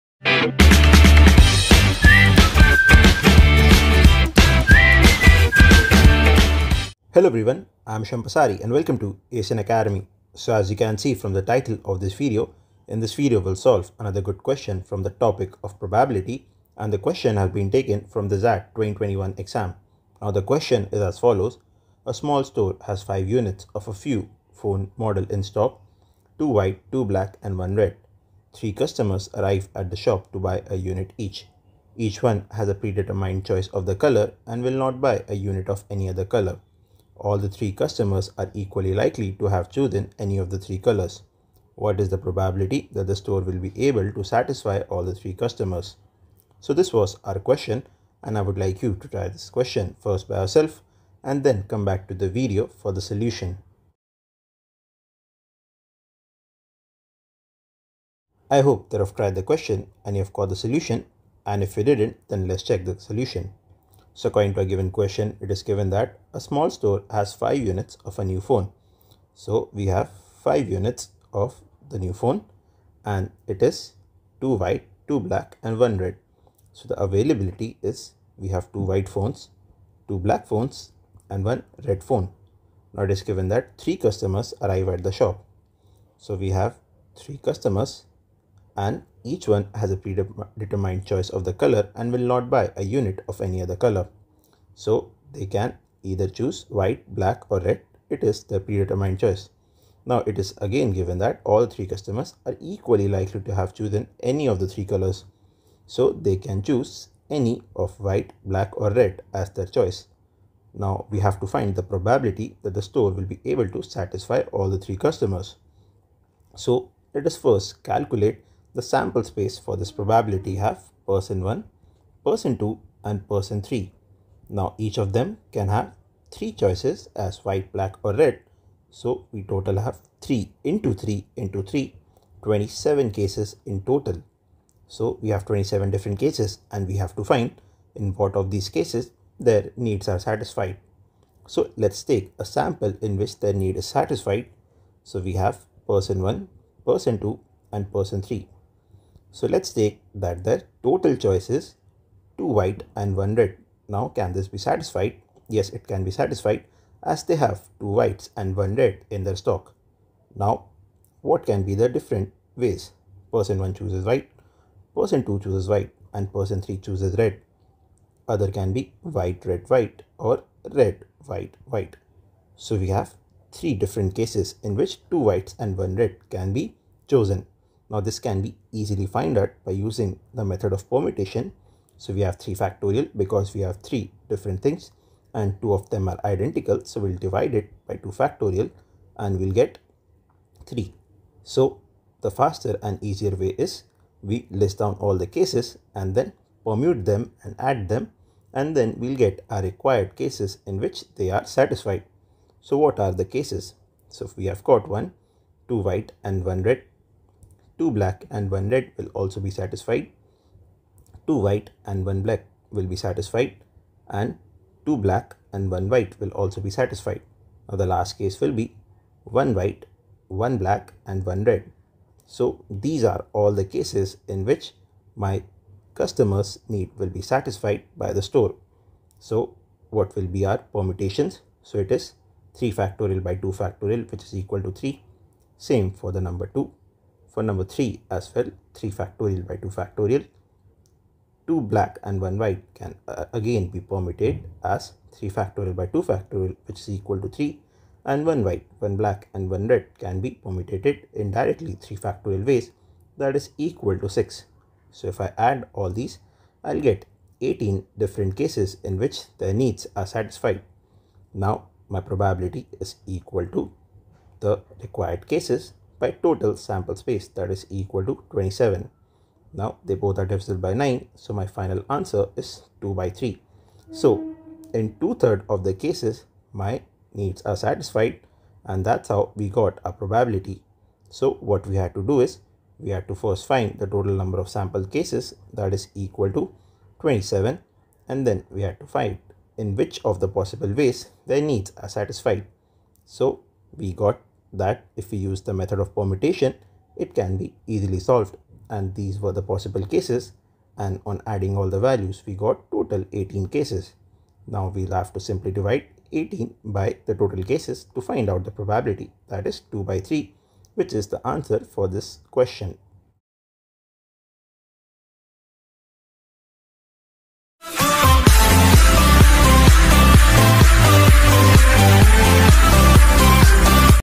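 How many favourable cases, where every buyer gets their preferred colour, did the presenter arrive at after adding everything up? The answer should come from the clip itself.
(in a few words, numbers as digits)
18.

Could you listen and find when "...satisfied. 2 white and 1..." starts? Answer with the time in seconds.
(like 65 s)
209 s.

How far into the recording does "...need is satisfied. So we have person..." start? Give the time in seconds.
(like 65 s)
143 s.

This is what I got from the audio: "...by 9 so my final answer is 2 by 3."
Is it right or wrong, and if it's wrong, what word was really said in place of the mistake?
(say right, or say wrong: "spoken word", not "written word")
right.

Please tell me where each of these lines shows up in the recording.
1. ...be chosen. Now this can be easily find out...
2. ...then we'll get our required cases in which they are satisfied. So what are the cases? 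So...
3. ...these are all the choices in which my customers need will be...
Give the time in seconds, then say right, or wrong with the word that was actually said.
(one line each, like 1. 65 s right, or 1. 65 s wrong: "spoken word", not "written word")
1. 176 s right
2. 198 s right
3. 222 s wrong: "cases", not "choices".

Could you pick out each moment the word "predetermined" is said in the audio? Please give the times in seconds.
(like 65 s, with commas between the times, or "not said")
32 s, 89 s, 98 s.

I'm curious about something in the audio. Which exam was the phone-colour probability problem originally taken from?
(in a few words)
XAT 2021.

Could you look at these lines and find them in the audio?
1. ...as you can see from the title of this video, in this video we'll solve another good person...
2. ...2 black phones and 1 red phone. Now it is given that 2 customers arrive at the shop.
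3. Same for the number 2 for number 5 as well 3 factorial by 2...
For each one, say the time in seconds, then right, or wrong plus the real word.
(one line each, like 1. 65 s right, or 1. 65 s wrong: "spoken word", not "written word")
1. 10 s wrong: "question", not "person"
2. 80 s wrong: "3", not "2"
3. 235 s wrong: "3", not "5".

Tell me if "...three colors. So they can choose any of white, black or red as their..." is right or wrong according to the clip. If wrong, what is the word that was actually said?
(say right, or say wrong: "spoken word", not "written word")
right.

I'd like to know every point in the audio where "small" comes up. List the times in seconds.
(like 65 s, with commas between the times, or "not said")
22 s, 66 s.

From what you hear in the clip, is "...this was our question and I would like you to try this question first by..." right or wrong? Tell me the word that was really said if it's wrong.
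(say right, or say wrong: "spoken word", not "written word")
right.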